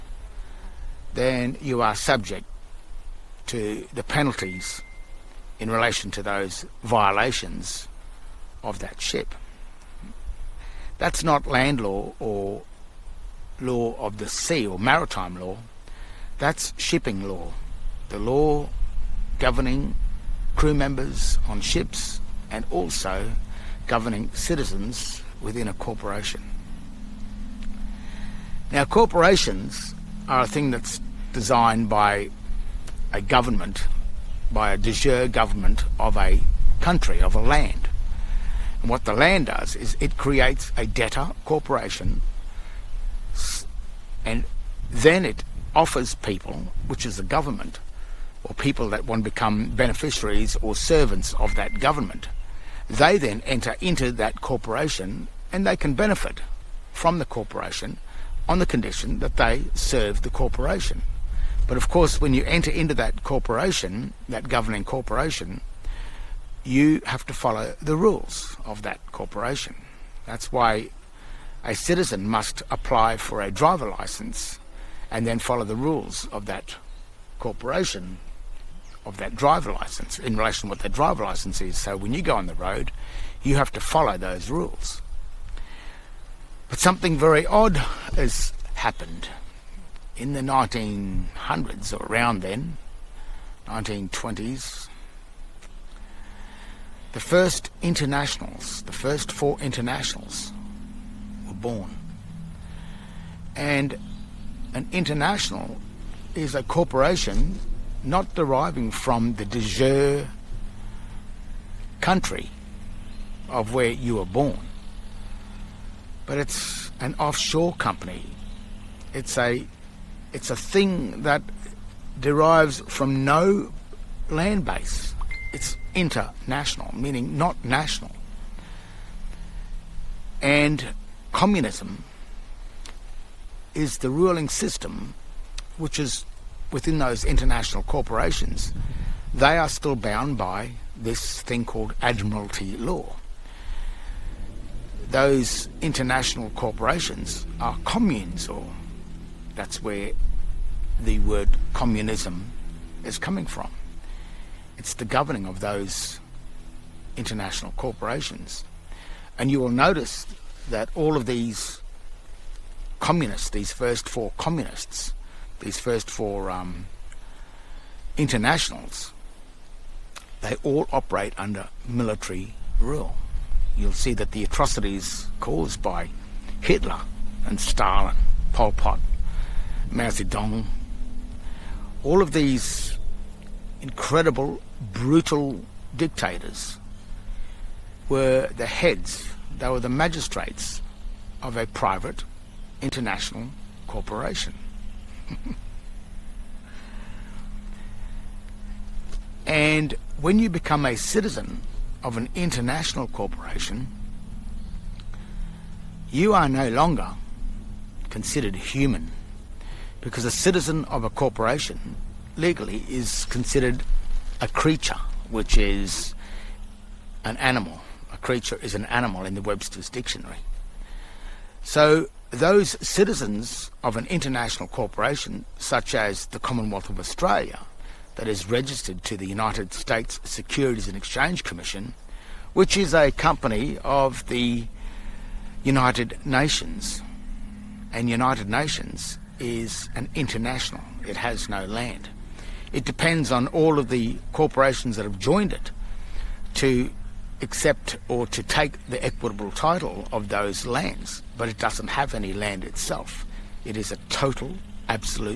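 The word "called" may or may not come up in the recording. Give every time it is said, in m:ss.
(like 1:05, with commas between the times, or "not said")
2:21.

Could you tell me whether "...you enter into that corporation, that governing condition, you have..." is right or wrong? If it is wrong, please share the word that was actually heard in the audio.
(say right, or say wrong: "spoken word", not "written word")
wrong: "corporation", not "condition".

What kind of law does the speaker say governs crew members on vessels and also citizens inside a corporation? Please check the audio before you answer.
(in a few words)
Shipping law.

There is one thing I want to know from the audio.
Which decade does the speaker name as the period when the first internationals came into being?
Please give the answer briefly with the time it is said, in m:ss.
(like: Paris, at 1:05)
1920s, at 1:33.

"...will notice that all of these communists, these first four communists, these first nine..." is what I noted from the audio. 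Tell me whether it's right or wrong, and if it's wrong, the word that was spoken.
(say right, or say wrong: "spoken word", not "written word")
wrong: "four", not "nine".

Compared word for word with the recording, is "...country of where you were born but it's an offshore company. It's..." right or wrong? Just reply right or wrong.
right.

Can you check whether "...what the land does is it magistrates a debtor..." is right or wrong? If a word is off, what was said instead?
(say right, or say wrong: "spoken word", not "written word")
wrong: "creates", not "magistrates".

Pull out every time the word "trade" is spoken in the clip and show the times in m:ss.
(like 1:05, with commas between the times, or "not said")
not said.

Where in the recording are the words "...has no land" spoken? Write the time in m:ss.
4:01.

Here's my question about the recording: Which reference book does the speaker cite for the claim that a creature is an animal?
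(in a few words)
Webster's dictionary.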